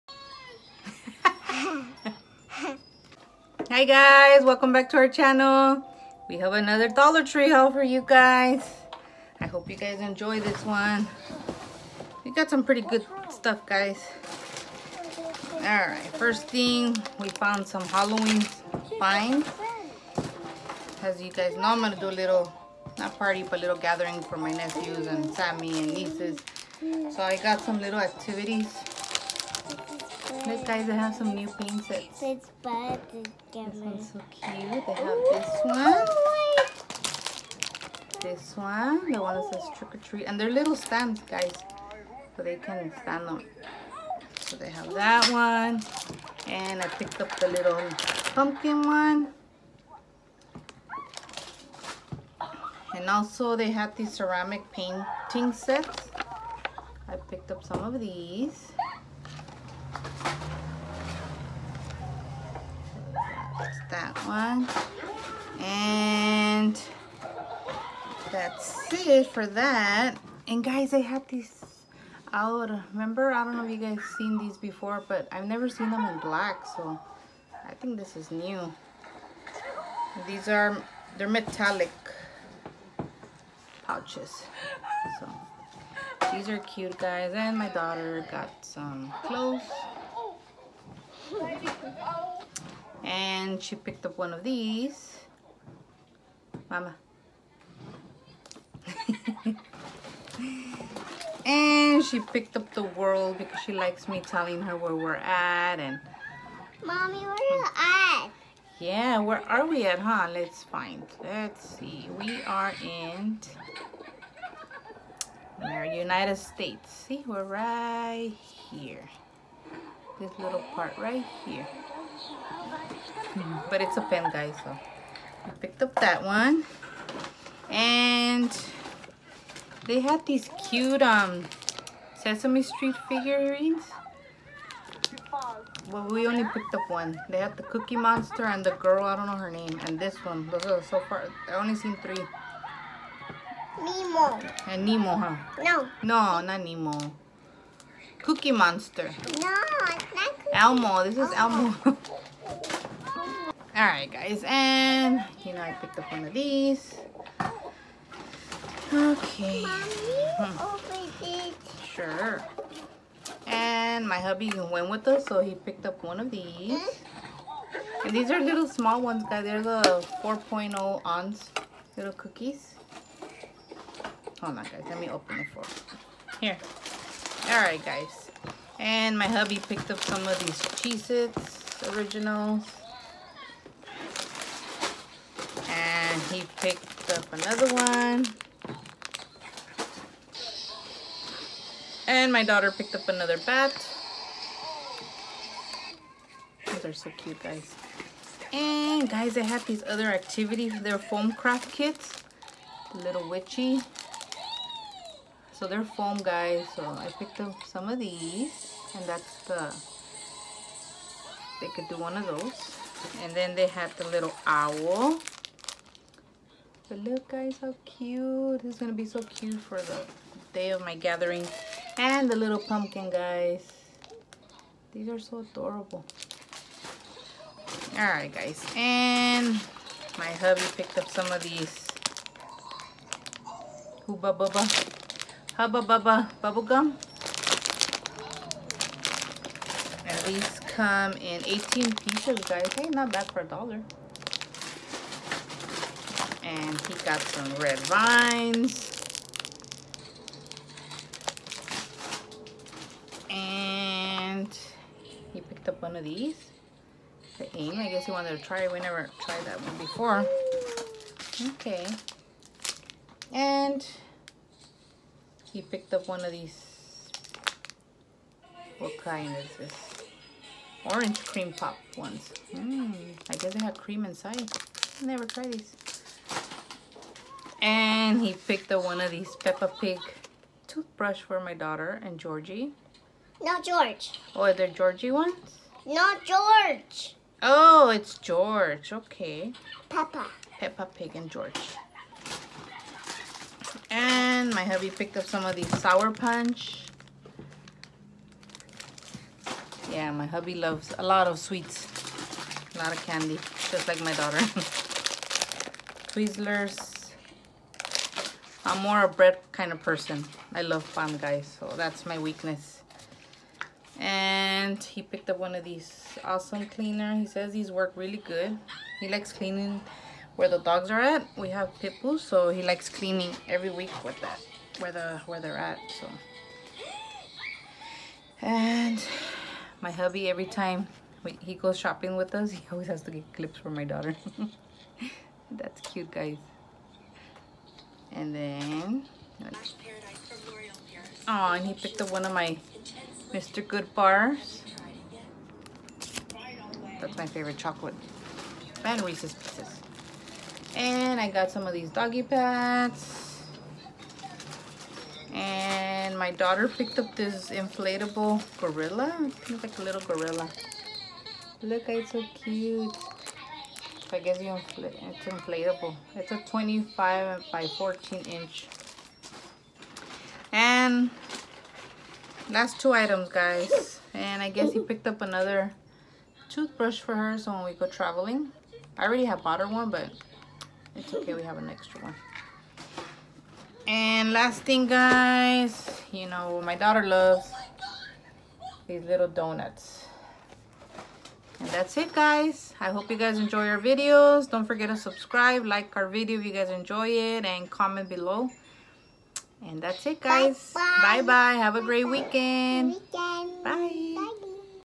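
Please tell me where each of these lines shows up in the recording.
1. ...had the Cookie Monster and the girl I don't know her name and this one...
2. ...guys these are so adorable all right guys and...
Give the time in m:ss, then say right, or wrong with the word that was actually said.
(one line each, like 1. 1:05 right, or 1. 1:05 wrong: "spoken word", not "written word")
1. 2:17 right
2. 3:43 right.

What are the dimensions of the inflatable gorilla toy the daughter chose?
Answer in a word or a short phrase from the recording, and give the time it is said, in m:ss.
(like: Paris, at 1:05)
25 by 14 inch, at 6:06.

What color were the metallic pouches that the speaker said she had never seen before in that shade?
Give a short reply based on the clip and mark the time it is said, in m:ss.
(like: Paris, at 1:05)
black, at 1:16.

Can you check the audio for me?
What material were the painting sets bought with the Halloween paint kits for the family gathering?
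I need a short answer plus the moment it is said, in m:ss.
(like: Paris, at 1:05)
ceramic, at 0:54.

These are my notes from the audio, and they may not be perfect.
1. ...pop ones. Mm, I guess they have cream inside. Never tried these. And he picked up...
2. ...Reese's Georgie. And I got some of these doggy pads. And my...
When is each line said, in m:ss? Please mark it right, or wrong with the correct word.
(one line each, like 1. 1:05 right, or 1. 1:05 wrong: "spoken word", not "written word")
1. 4:31 right
2. 5:49 wrong: "Pieces", not "Georgie".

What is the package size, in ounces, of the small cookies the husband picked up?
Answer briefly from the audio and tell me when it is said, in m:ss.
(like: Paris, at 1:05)
4.0 ounces, at 2:50.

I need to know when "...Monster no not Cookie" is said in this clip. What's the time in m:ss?
2:28.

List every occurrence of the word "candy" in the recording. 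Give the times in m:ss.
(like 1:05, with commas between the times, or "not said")
5:03.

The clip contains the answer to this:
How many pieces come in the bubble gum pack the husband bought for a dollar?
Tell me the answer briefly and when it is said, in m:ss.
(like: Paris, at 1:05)
18, at 4:01.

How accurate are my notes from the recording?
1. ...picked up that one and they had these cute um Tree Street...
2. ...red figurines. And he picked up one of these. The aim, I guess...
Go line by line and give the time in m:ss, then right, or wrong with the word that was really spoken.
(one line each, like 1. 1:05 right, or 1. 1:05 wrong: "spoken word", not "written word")
1. 2:05 wrong: "Sesame", not "Tree"
2. 4:07 wrong: "vines", not "figurines".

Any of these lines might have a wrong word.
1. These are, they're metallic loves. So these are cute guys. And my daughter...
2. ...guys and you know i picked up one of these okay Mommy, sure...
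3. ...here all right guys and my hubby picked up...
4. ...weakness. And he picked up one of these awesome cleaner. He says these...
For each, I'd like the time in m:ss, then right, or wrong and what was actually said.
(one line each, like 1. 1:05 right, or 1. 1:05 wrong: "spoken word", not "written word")
1. 1:20 wrong: "pouches", not "loves"
2. 2:34 right
3. 2:56 right
4. 5:12 right.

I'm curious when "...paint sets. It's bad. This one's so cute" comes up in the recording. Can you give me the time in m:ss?
0:31.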